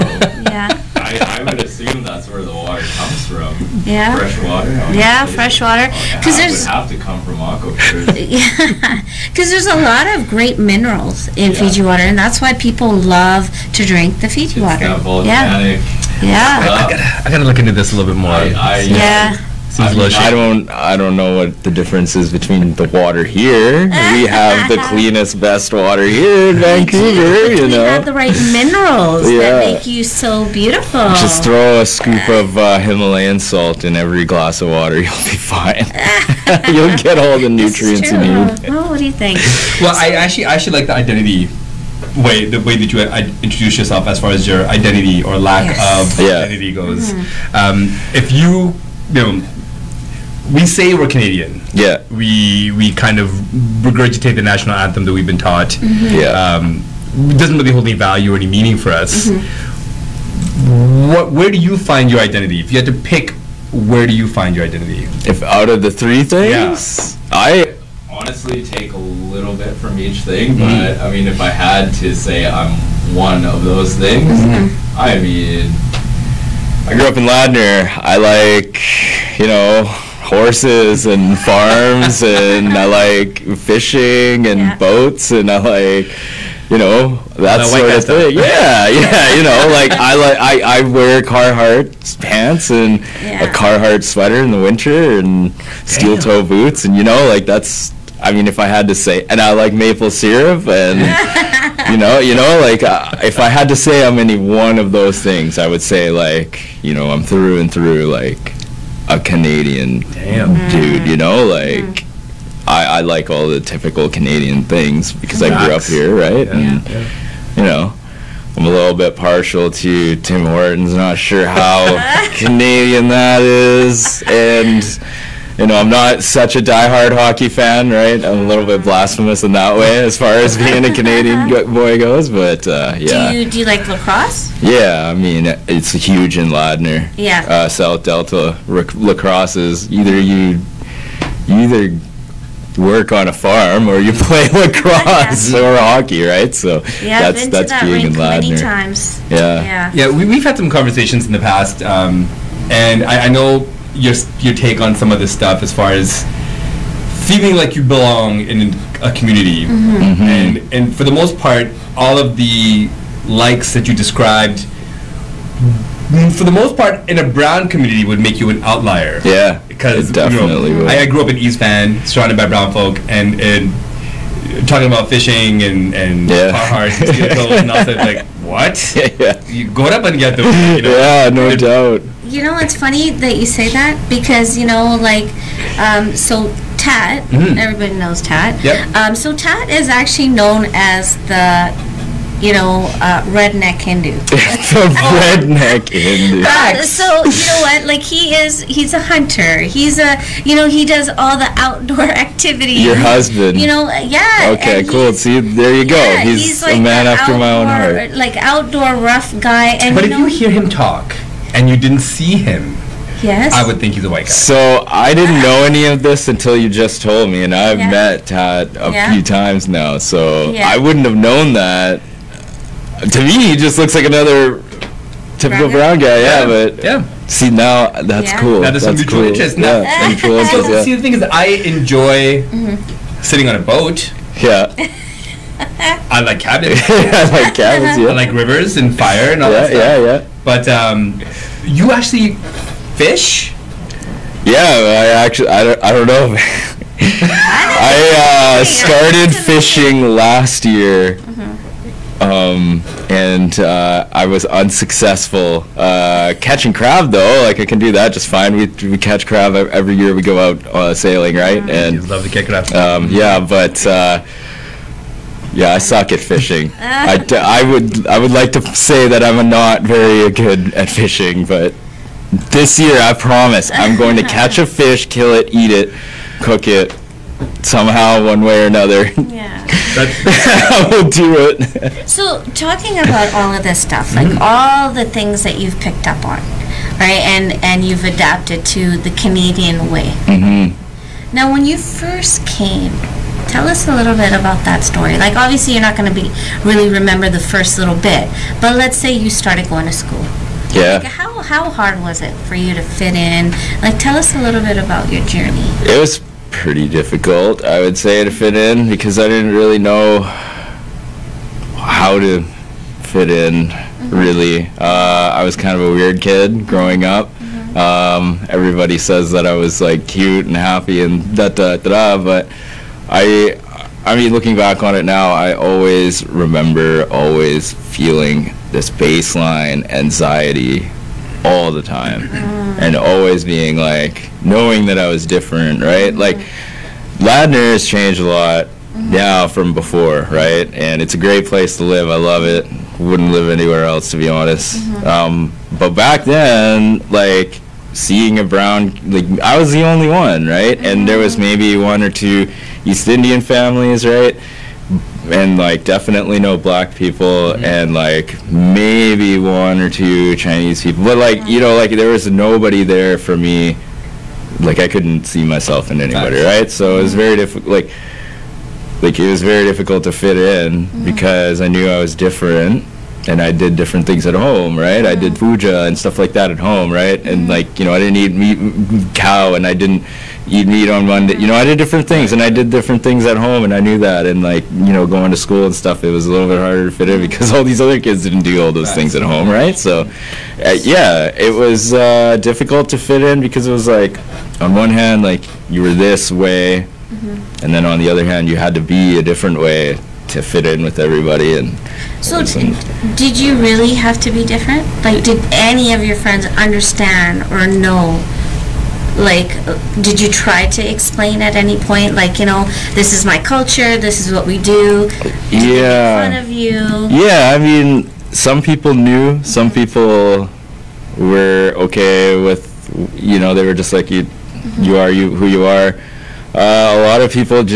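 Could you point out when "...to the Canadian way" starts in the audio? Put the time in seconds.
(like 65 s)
288 s.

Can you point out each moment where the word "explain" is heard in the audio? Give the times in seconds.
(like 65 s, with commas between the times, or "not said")
410 s.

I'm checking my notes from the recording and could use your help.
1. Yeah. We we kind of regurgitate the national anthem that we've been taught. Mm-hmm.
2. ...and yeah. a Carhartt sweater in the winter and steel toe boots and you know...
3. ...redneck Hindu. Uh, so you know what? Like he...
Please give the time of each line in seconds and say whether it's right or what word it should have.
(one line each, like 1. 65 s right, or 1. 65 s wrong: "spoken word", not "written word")
1. 51 s right
2. 92 s right
3. 195 s right.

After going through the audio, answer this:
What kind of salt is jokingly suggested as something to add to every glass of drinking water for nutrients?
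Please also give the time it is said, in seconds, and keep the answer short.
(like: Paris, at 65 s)
Himalayan salt, at 32 s.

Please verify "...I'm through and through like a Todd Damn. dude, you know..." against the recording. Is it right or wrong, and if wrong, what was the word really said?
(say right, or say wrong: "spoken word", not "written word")
wrong: "Canadian", not "Todd".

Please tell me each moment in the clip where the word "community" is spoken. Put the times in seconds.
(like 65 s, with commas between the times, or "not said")
159 s, 167 s.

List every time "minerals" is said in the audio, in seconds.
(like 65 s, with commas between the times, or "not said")
10 s, 28 s.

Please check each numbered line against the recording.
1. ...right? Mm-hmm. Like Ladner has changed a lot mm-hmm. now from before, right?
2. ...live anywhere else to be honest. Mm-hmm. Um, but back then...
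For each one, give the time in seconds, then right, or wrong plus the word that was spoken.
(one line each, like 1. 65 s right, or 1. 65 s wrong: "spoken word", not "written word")
1. 335 s right
2. 343 s right.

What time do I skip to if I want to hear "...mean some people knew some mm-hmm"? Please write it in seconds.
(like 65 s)
417 s.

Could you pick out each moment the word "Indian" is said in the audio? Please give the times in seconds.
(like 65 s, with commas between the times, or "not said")
353 s.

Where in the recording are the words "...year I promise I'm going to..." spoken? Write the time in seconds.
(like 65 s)
272 s.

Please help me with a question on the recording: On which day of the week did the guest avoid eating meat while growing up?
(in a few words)
Monday.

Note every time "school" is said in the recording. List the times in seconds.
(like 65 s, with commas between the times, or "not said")
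299 s, 385 s.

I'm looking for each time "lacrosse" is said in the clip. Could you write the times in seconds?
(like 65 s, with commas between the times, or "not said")
133 s, 138 s, 144 s.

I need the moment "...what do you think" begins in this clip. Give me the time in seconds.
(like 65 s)
38 s.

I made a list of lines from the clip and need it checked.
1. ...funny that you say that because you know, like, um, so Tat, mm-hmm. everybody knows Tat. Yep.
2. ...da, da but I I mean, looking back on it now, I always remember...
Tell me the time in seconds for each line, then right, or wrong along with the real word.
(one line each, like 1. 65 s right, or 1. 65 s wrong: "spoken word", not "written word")
1. 182 s right
2. 321 s right.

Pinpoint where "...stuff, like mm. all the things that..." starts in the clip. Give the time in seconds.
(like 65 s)
283 s.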